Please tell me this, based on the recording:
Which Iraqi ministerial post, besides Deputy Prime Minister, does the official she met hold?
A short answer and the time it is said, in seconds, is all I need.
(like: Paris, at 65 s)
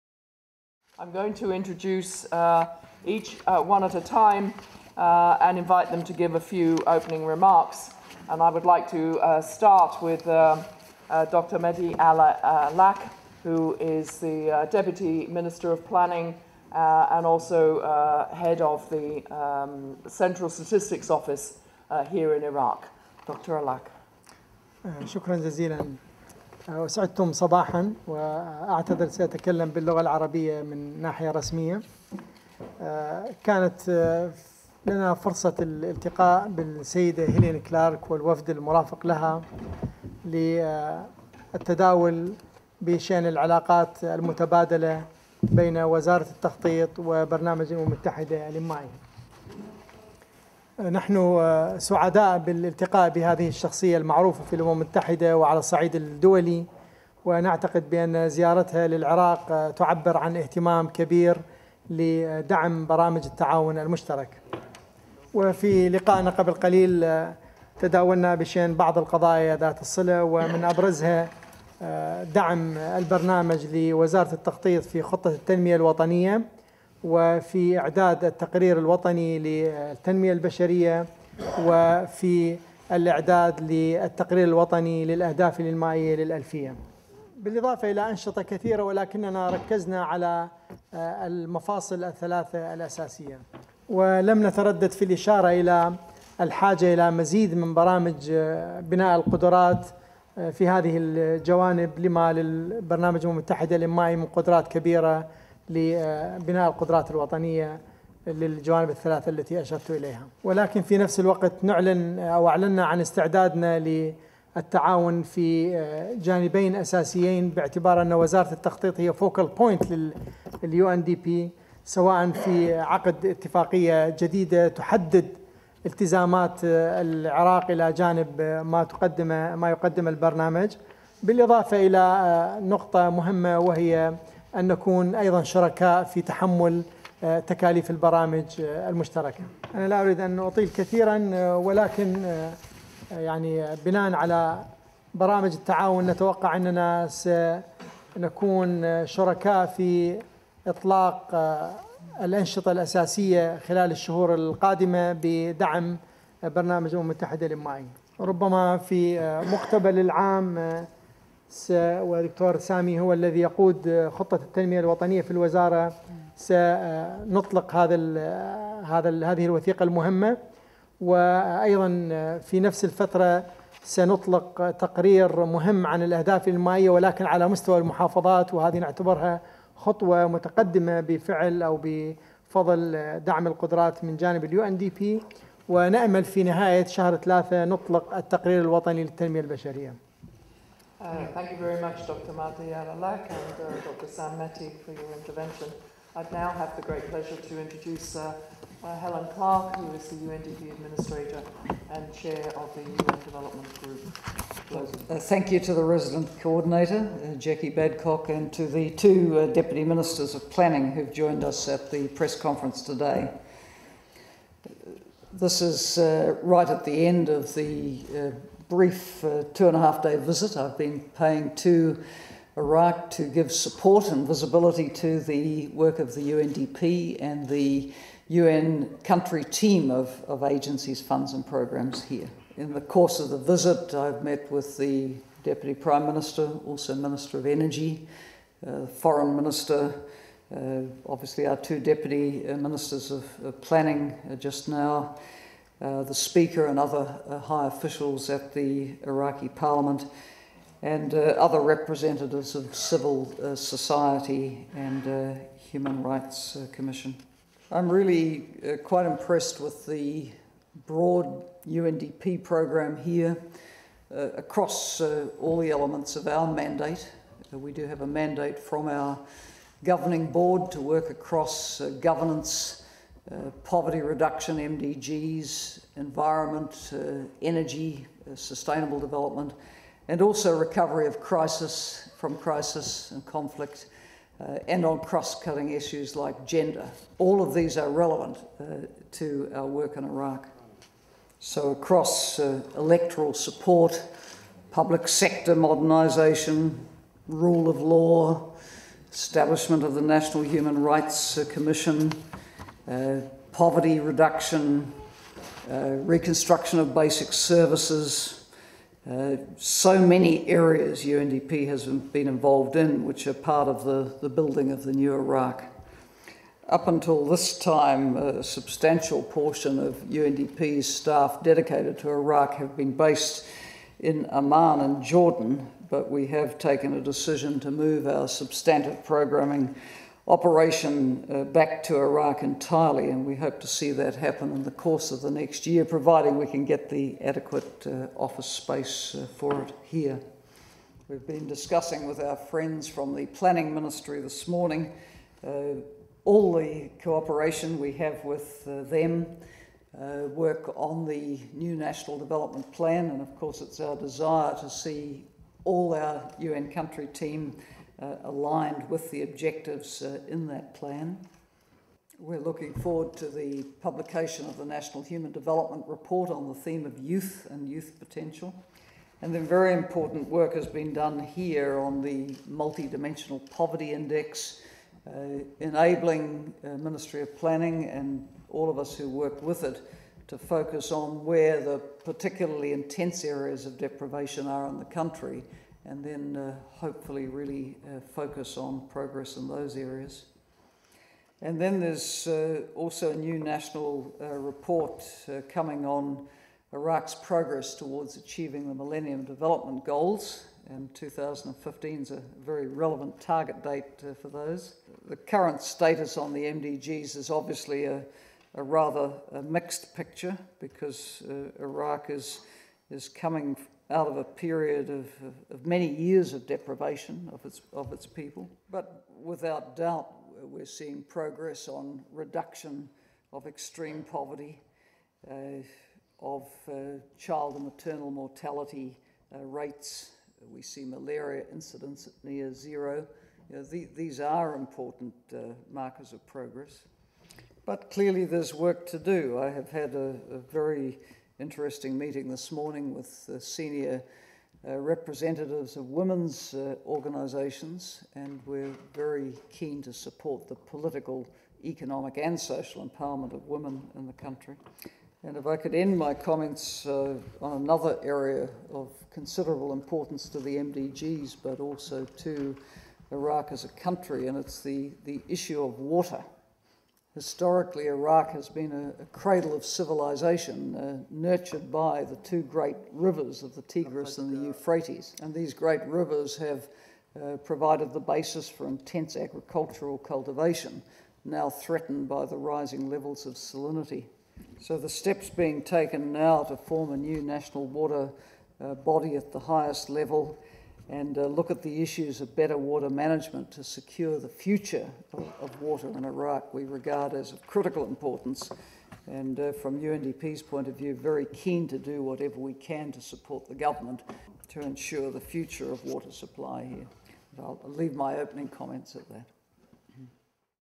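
Minister of Energy, at 236 s.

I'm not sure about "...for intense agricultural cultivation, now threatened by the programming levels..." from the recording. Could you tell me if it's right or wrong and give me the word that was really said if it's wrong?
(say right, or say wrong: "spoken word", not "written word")
wrong: "rising", not "programming".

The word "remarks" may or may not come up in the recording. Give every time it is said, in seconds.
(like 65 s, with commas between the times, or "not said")
7 s.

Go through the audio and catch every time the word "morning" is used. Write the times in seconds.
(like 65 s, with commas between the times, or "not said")
344 s, 442 s.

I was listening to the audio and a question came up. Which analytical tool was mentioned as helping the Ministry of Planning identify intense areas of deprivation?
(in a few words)
multidimensional poverty index.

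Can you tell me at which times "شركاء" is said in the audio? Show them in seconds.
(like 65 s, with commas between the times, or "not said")
135 s, 149 s.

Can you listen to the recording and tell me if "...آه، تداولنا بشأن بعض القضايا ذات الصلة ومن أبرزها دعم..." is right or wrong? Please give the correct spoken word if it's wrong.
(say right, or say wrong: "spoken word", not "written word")
right.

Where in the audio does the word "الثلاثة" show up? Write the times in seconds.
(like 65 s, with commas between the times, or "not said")
92 s, 108 s.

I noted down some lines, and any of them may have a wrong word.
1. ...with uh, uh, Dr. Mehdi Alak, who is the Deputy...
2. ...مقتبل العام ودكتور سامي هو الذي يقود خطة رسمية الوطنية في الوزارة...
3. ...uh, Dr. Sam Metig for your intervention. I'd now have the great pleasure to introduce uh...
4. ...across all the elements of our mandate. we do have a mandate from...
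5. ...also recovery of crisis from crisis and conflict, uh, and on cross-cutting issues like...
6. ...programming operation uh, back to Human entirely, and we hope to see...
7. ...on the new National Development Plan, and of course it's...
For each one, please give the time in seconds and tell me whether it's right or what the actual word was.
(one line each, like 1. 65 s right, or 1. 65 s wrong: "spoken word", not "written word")
1. 10 s right
2. 159 s wrong: "التنمية", not "رسمية"
3. 193 s right
4. 264 s right
5. 280 s right
6. 329 s wrong: "Iraq", not "Human"
7. 350 s right.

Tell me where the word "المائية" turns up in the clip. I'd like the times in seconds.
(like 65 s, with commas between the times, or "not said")
85 s, 176 s.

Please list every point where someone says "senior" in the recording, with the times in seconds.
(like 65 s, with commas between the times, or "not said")
443 s.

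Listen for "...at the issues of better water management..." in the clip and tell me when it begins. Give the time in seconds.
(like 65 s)
491 s.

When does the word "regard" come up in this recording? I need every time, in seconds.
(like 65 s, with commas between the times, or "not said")
496 s.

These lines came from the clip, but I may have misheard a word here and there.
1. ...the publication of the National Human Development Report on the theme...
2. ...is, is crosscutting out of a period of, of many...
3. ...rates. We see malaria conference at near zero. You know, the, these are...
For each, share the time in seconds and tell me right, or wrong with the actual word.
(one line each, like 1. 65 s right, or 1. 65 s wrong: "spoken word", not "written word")
1. 363 s right
2. 412 s wrong: "coming", not "crosscutting"
3. 429 s wrong: "incidence", not "conference".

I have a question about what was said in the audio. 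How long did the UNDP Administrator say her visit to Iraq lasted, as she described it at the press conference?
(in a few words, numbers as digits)
2 and a half days.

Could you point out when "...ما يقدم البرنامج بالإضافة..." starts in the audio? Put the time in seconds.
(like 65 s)
129 s.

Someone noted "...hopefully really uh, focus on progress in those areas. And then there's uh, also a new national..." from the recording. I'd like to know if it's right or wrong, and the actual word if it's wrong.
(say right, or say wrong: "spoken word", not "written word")
right.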